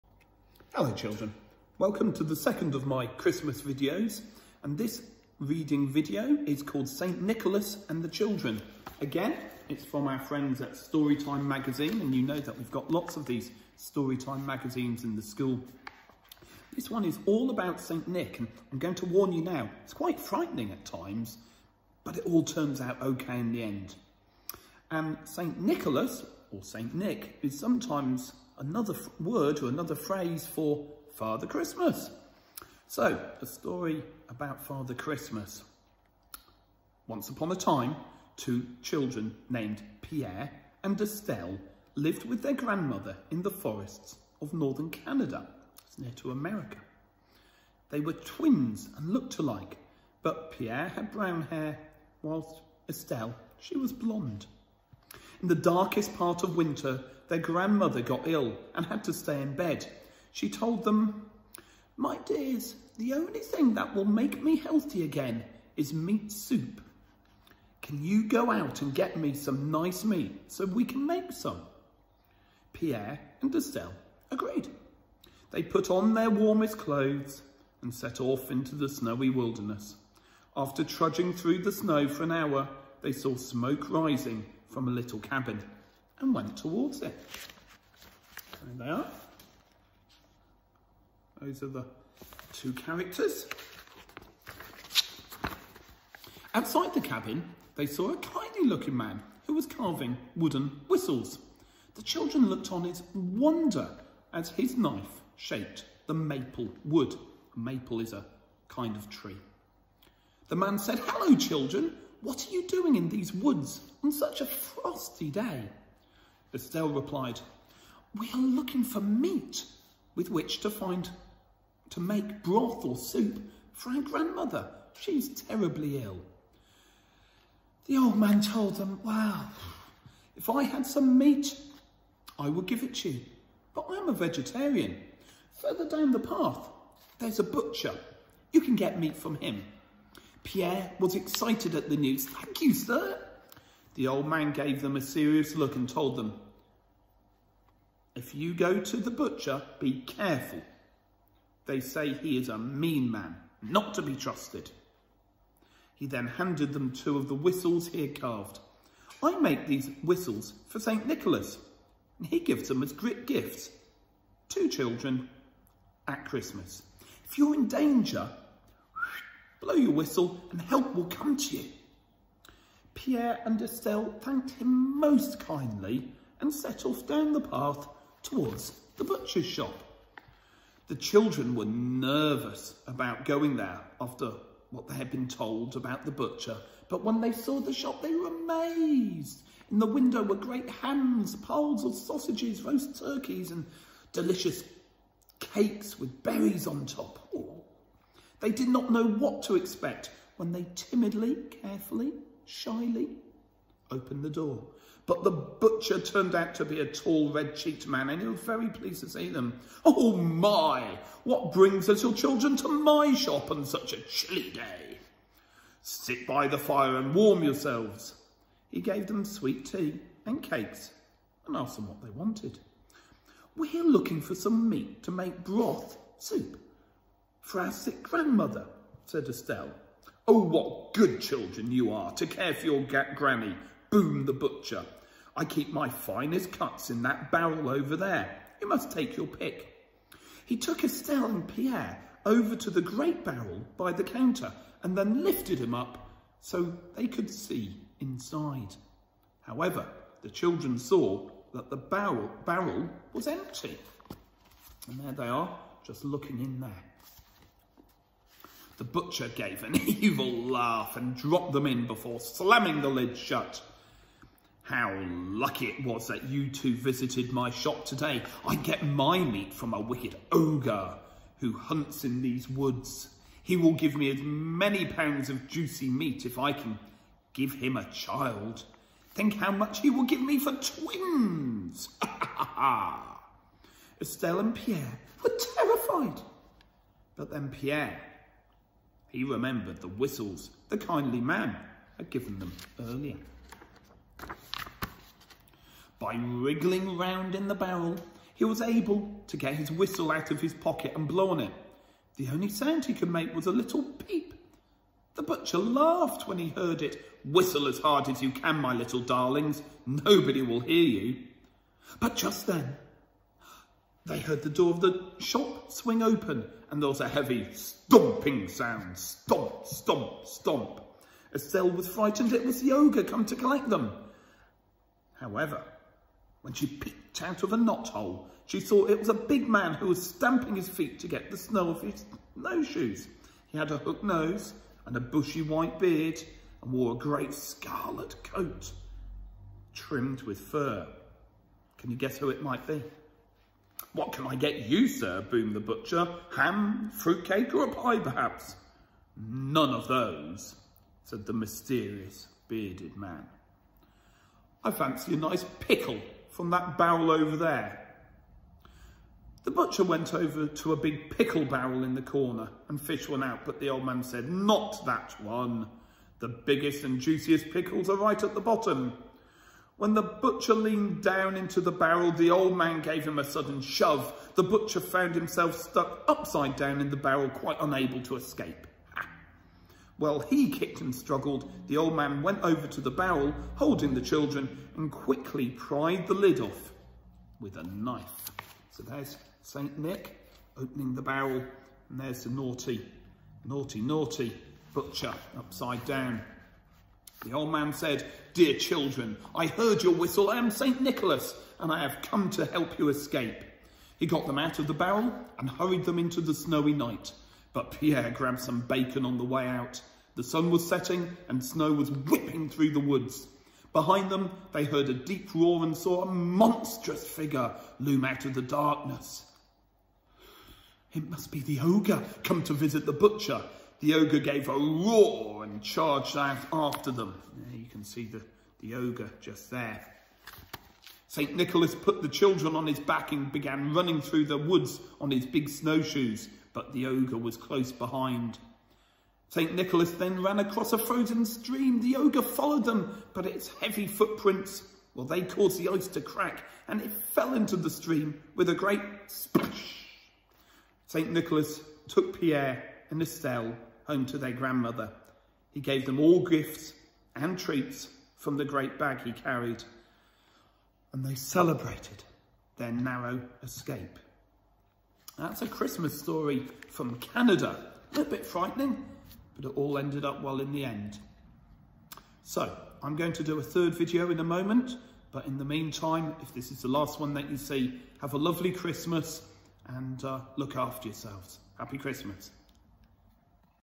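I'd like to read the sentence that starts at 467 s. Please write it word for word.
A little bit frightening, but it all ended up well in the end.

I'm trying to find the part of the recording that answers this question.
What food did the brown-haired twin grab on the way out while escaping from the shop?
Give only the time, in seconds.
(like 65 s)
408 s.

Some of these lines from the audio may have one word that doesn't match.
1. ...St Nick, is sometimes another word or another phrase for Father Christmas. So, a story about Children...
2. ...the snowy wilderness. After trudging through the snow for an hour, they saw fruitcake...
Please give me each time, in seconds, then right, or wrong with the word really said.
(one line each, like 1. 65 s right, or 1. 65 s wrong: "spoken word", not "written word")
1. 26 s wrong: "Father", not "Children"
2. 78 s wrong: "smoke", not "fruitcake".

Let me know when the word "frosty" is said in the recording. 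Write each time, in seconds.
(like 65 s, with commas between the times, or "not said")
114 s.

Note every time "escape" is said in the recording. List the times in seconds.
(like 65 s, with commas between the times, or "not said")
378 s, 402 s, 463 s.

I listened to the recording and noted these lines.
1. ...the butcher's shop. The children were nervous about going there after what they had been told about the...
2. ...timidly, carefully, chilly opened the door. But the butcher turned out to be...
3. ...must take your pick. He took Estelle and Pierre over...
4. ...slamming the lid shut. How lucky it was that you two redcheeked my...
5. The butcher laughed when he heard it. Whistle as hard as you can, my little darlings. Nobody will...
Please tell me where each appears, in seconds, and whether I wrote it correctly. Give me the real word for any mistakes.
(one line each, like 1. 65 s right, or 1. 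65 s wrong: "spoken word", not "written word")
1. 178 s right
2. 200 s wrong: "shyly", not "chilly"
3. 238 s right
4. 262 s wrong: "visited", not "redcheeked"
5. 305 s right.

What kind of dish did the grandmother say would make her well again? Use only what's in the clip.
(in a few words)
Meat soup.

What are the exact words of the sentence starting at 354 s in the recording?
I fancy a nice pickle from that barrel over there.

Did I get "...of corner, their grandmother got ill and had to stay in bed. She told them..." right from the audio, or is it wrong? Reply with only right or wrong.
wrong.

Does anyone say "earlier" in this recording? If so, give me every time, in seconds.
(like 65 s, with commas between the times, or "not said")
292 s.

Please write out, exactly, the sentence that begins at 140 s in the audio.
Pierre was excited at the news.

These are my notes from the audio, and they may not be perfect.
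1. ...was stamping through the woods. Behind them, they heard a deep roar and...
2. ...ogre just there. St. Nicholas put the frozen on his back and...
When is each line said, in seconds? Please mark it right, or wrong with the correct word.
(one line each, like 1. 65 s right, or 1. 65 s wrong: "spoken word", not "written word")
1. 411 s wrong: "whipping", not "stamping"
2. 428 s wrong: "children", not "frozen".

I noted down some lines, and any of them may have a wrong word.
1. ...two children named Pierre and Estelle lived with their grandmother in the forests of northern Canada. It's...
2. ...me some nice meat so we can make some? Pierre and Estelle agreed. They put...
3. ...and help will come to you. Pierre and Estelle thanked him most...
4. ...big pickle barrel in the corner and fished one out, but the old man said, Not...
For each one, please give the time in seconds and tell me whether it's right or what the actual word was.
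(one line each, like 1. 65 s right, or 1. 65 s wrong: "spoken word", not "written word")
1. 38 s right
2. 69 s right
3. 170 s right
4. 360 s right.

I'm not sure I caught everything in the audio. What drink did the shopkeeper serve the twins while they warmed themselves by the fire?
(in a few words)
Sweet tea.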